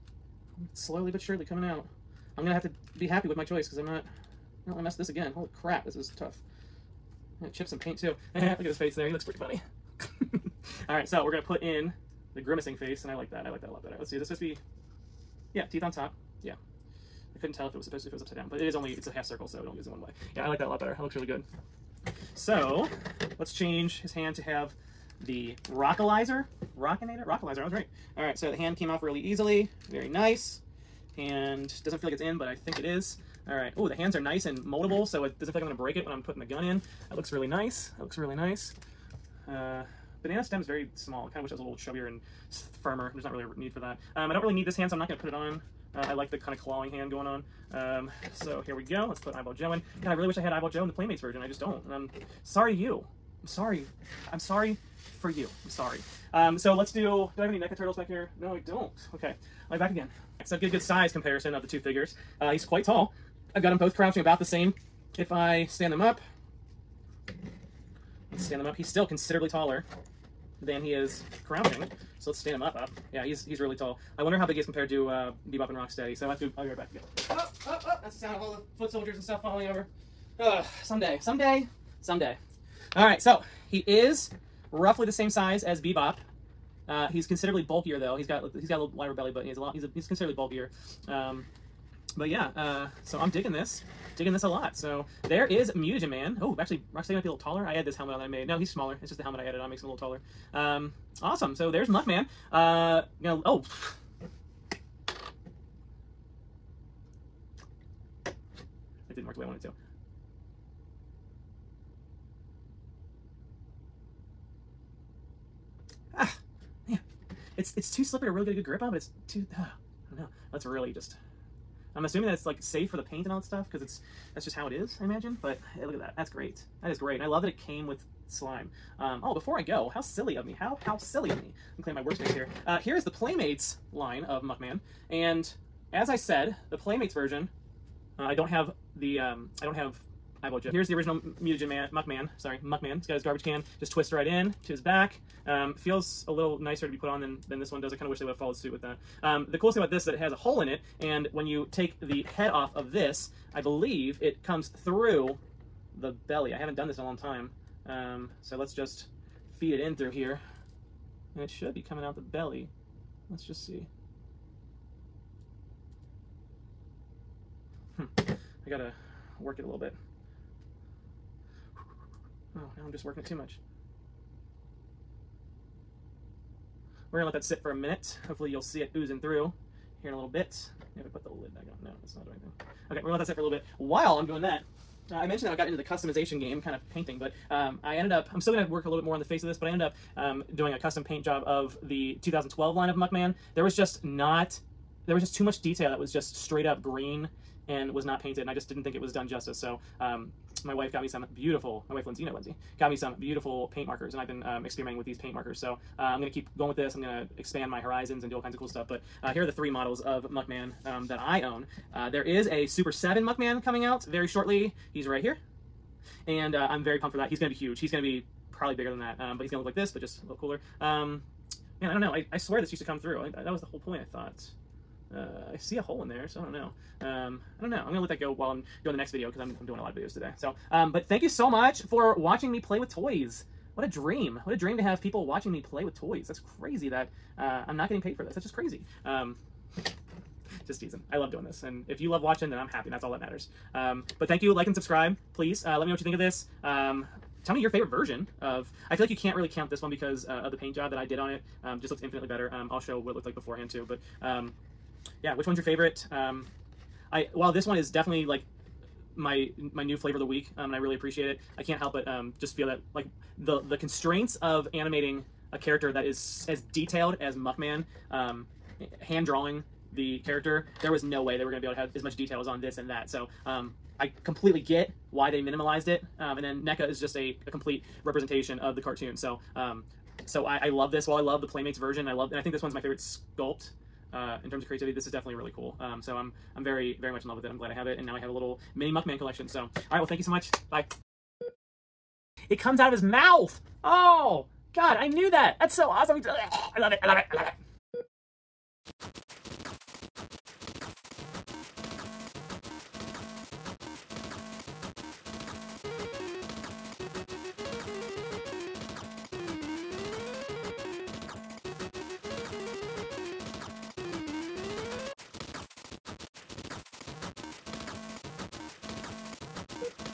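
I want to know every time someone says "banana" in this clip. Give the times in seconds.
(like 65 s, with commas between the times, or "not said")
40 s.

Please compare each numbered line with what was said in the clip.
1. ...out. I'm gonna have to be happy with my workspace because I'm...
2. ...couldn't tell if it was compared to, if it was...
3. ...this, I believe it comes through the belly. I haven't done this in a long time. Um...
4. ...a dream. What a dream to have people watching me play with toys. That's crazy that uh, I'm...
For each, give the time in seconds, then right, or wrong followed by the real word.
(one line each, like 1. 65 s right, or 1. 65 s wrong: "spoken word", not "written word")
1. 1 s wrong: "choice", not "workspace"
2. 17 s wrong: "supposed", not "compared"
3. 152 s right
4. 233 s right.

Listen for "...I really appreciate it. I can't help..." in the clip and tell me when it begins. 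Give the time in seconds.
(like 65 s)
260 s.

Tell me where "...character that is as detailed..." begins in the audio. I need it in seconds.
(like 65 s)
265 s.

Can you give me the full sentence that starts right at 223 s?
I, I, that was the whole point, I thought.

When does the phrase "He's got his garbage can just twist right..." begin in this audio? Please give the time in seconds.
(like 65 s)
143 s.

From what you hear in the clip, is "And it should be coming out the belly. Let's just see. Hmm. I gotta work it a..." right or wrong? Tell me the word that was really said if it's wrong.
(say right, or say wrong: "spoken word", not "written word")
right.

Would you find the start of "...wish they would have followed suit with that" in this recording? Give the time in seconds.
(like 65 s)
148 s.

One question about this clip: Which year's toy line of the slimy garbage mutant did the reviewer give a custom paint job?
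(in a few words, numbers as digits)
2012.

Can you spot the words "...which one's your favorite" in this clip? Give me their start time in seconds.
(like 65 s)
255 s.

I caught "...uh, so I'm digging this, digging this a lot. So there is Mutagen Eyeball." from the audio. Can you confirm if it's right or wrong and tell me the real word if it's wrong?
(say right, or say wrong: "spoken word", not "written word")
wrong: "Man", not "Eyeball".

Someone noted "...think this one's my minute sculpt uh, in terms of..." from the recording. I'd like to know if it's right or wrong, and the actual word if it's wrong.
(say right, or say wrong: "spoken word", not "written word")
wrong: "favorite", not "minute".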